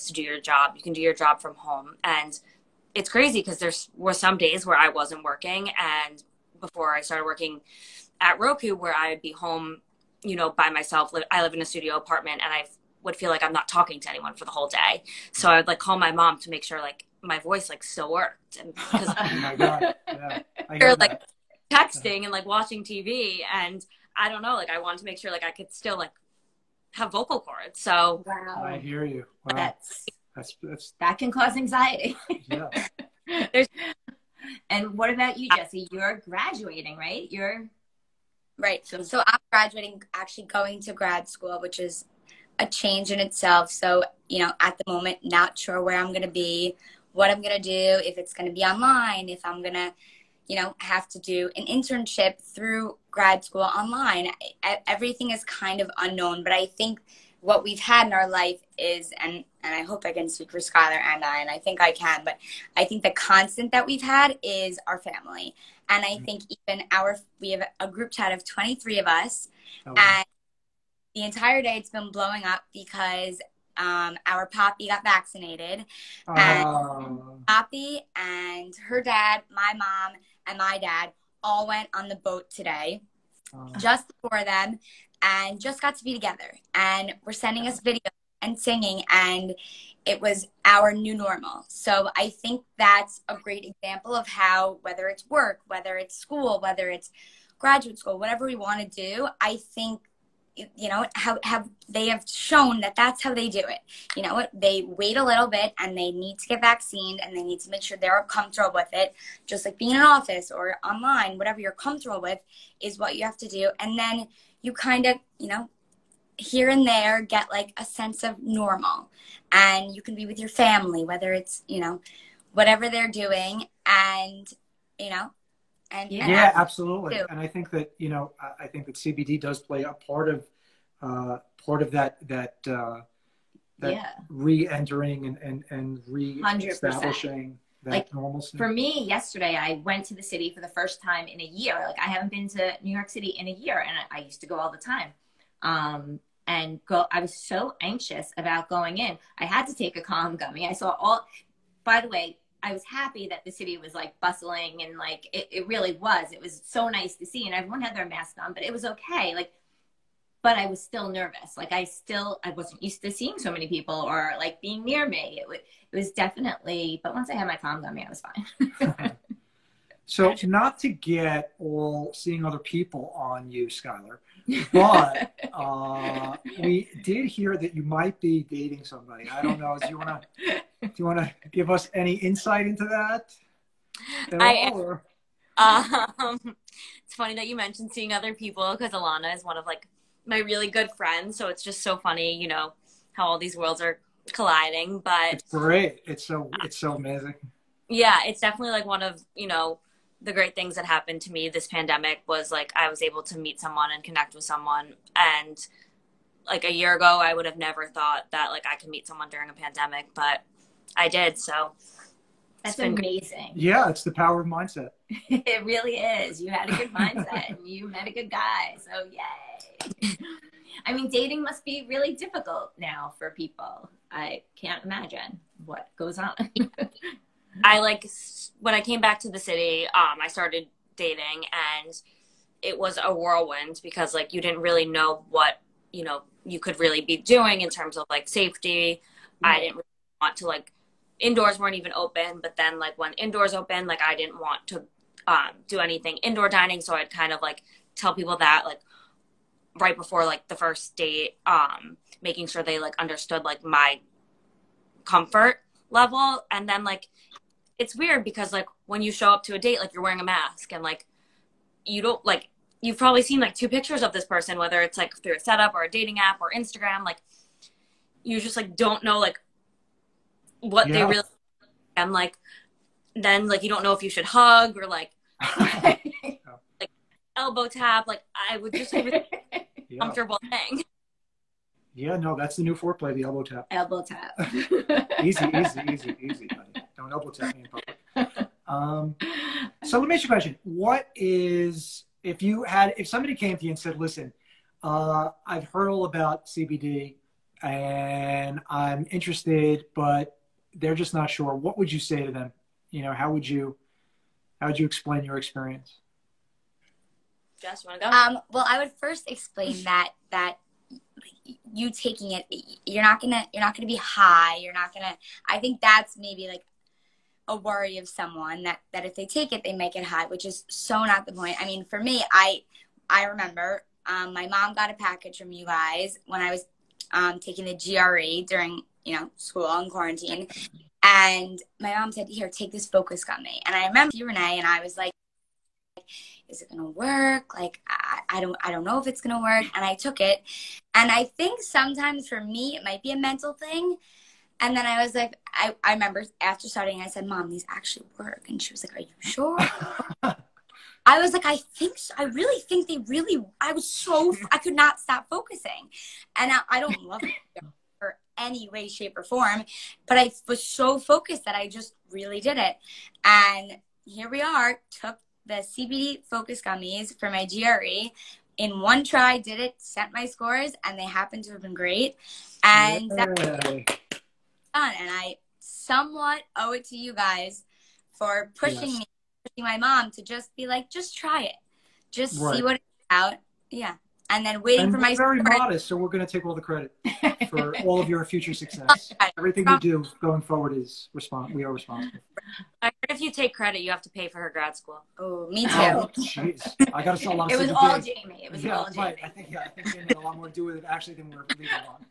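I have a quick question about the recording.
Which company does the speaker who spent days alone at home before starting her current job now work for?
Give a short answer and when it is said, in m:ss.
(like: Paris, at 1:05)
Roku, at 0:08.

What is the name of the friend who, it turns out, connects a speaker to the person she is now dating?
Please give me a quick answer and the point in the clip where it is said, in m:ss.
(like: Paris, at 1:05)
Alana, at 3:08.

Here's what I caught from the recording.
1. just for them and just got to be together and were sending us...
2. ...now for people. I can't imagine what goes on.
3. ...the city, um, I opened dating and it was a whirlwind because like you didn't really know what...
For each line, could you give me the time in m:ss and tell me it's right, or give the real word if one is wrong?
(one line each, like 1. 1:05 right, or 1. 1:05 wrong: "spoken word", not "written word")
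1. 1:23 right
2. 3:42 right
3. 3:49 wrong: "started", not "opened".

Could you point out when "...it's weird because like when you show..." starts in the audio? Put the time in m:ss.
4:17.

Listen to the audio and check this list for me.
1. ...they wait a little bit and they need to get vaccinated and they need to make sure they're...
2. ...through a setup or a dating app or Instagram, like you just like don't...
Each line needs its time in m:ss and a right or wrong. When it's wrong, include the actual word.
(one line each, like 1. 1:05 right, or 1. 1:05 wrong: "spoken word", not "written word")
1. 1:44 right
2. 4:25 right.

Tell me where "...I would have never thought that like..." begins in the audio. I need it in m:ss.
3:27.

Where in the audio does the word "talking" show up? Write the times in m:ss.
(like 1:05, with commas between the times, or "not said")
0:13.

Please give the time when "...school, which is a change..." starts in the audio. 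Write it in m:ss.
0:41.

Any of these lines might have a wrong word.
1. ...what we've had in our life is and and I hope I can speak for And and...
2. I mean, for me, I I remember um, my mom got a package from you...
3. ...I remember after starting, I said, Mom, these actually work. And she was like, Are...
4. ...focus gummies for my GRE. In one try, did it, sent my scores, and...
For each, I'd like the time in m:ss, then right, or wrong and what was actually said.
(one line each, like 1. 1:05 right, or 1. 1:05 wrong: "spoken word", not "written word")
1. 0:57 wrong: "Skylar", not "And"
2. 5:21 right
3. 5:45 right
4. 6:06 right.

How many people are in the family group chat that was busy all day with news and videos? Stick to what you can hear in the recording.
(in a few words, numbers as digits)
23.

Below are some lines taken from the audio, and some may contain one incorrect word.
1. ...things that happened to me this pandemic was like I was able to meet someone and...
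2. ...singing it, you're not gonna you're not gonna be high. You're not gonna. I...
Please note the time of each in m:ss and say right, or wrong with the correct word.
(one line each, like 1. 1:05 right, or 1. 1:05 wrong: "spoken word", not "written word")
1. 3:20 right
2. 5:11 wrong: "taking", not "singing".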